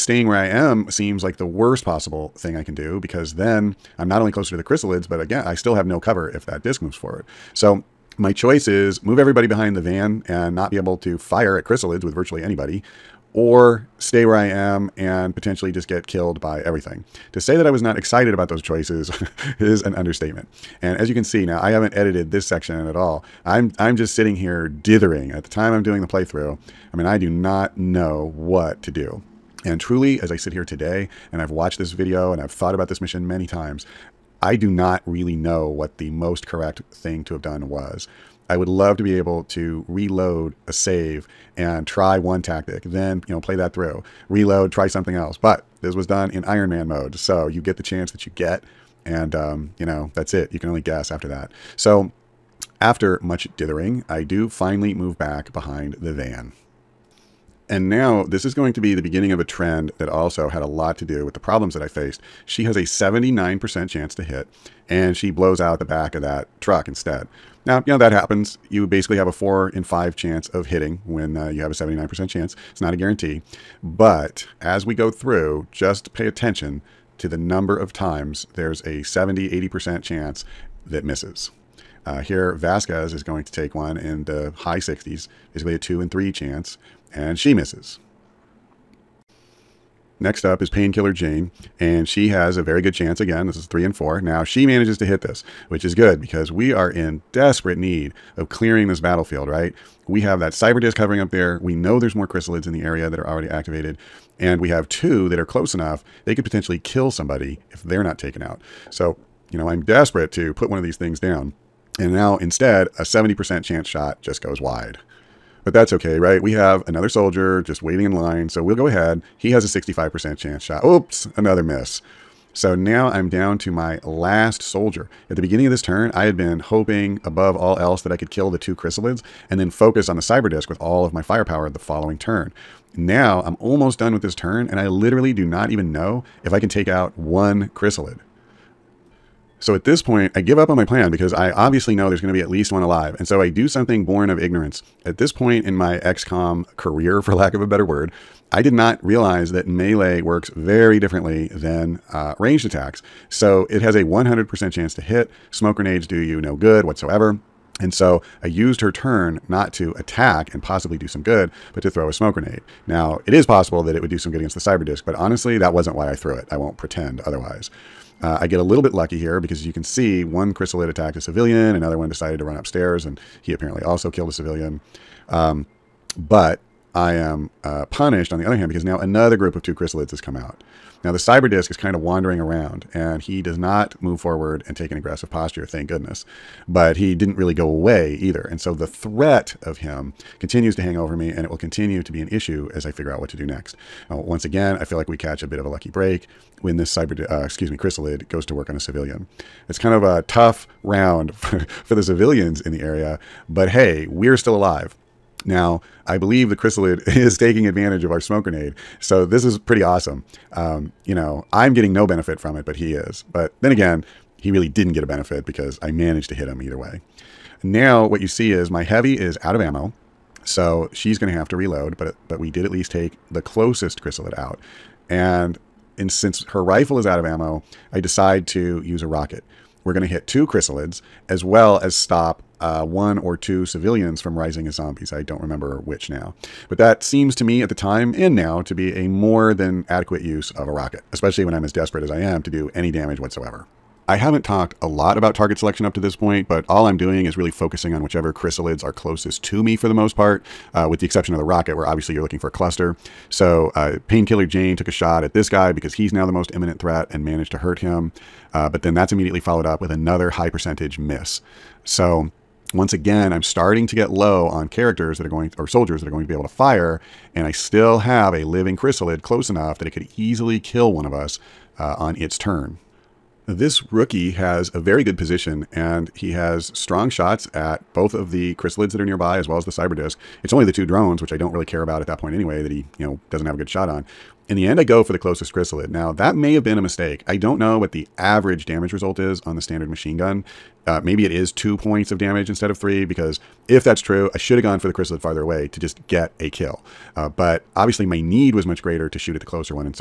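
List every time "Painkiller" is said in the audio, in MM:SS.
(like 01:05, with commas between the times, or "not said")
01:30, 04:14.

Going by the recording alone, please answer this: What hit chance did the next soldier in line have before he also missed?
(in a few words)
65%.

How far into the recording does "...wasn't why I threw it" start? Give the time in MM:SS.
02:45.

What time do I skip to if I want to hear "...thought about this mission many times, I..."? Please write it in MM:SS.
00:32.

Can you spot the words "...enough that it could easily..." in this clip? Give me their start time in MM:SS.
04:29.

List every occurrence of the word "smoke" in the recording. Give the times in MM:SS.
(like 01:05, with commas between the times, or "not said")
02:35, 02:42, 03:28.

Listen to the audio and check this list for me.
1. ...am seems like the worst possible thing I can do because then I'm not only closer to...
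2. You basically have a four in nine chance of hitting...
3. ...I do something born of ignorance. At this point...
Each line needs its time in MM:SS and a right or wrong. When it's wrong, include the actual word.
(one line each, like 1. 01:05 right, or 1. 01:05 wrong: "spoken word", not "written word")
1. 00:00 right
2. 01:08 wrong: "five", not "nine"
3. 02:23 right.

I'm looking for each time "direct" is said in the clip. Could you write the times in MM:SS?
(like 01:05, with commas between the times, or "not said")
not said.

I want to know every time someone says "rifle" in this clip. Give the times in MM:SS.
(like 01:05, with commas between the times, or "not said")
03:46.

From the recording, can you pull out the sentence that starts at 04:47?
I don't know what the average damage result is on the standard machine gun.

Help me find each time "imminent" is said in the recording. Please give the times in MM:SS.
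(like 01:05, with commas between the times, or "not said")
04:16.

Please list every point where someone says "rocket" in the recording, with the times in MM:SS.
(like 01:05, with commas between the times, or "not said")
03:49, 04:00, 04:11.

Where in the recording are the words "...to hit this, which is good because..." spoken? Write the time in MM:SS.
01:34.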